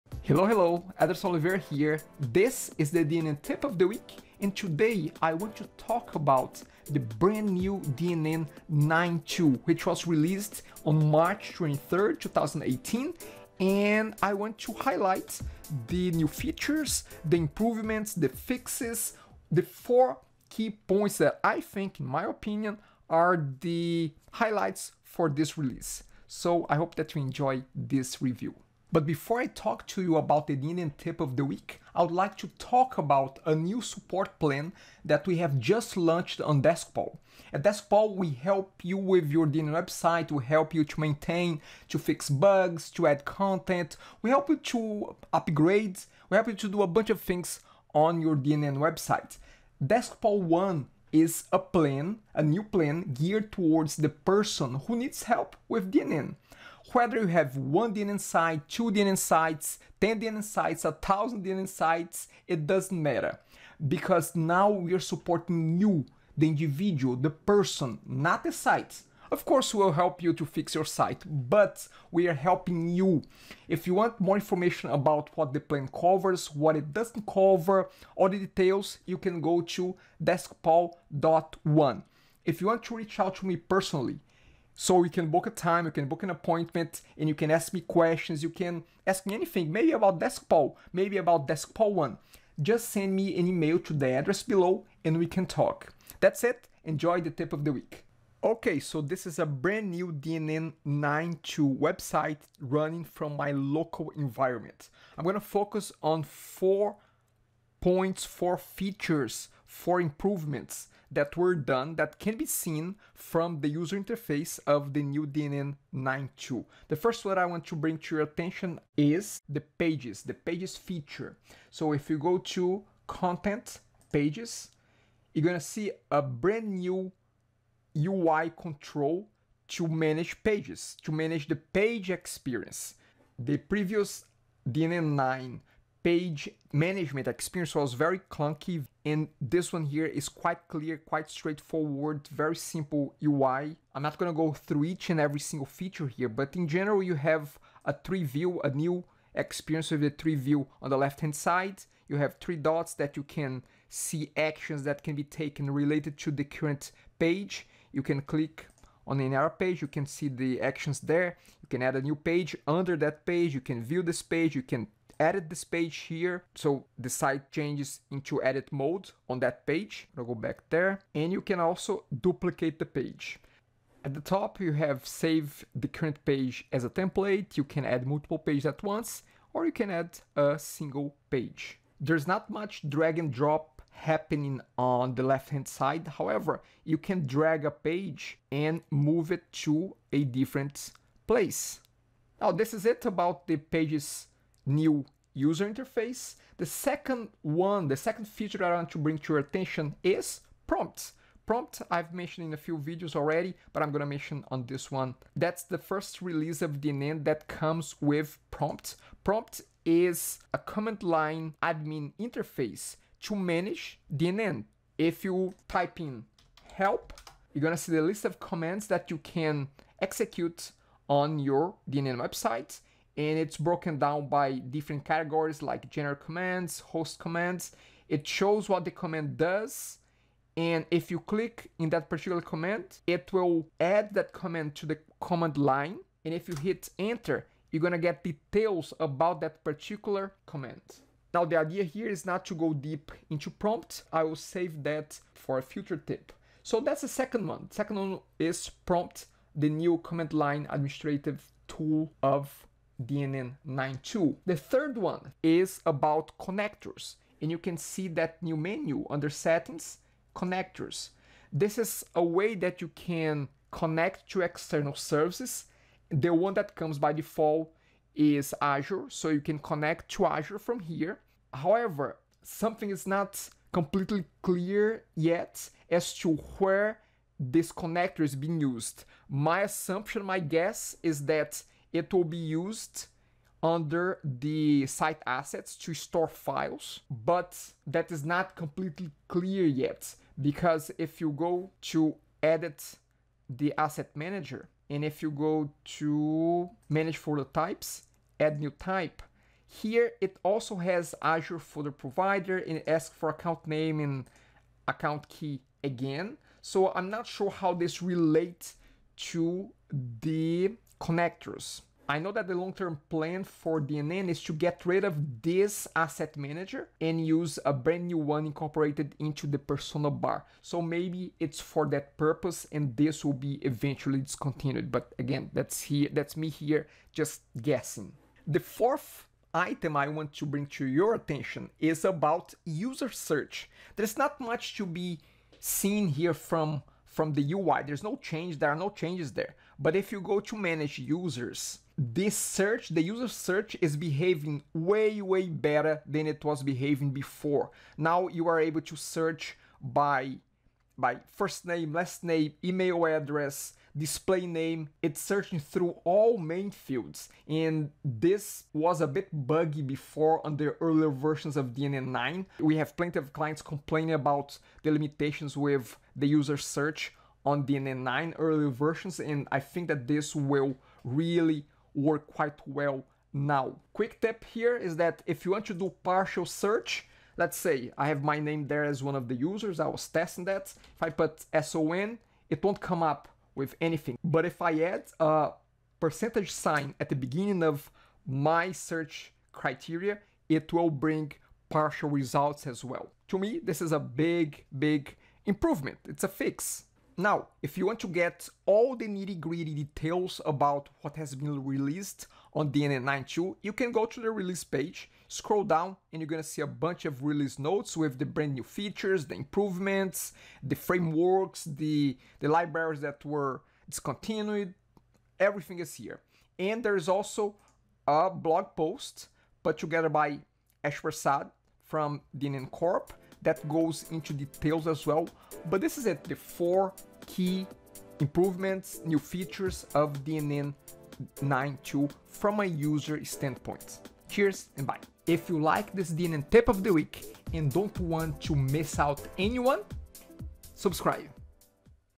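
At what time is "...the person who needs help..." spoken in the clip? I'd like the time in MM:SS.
00:53.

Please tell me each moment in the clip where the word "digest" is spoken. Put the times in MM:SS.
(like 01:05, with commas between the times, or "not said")
not said.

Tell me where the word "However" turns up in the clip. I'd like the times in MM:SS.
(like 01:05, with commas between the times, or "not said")
03:06, 04:31.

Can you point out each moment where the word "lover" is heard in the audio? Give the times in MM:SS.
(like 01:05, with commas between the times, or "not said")
not said.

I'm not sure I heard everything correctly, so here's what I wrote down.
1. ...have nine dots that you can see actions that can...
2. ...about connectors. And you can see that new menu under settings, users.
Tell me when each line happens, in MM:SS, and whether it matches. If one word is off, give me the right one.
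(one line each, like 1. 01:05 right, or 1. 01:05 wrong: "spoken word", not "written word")
1. 02:32 wrong: "three", not "nine"
2. 04:15 wrong: "connectors", not "users".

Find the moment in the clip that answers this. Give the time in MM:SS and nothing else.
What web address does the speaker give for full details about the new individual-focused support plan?
01:20.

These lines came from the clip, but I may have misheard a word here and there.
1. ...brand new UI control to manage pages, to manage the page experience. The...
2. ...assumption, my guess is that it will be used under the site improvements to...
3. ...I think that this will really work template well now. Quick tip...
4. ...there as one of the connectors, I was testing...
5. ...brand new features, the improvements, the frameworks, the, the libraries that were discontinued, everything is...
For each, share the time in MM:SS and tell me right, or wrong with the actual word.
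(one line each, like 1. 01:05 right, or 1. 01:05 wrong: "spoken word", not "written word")
1. 02:06 right
2. 04:39 wrong: "assets", not "improvements"
3. 06:09 wrong: "quite", not "template"
4. 06:18 wrong: "users", not "connectors"
5. 06:48 right.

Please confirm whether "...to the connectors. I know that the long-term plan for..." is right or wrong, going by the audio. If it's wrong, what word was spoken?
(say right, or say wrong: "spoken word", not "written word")
right.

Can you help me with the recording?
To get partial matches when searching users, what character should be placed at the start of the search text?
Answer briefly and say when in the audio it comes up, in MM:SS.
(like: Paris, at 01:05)
percentage sign, at 06:25.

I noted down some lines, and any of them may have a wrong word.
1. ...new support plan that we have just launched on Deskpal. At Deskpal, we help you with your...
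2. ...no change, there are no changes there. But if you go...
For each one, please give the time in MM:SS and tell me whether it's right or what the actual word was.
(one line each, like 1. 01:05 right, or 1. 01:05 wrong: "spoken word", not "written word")
1. 00:33 right
2. 05:38 right.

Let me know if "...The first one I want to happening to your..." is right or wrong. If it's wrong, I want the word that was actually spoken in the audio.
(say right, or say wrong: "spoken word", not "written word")
wrong: "bring", not "happening".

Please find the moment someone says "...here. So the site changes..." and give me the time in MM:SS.
02:46.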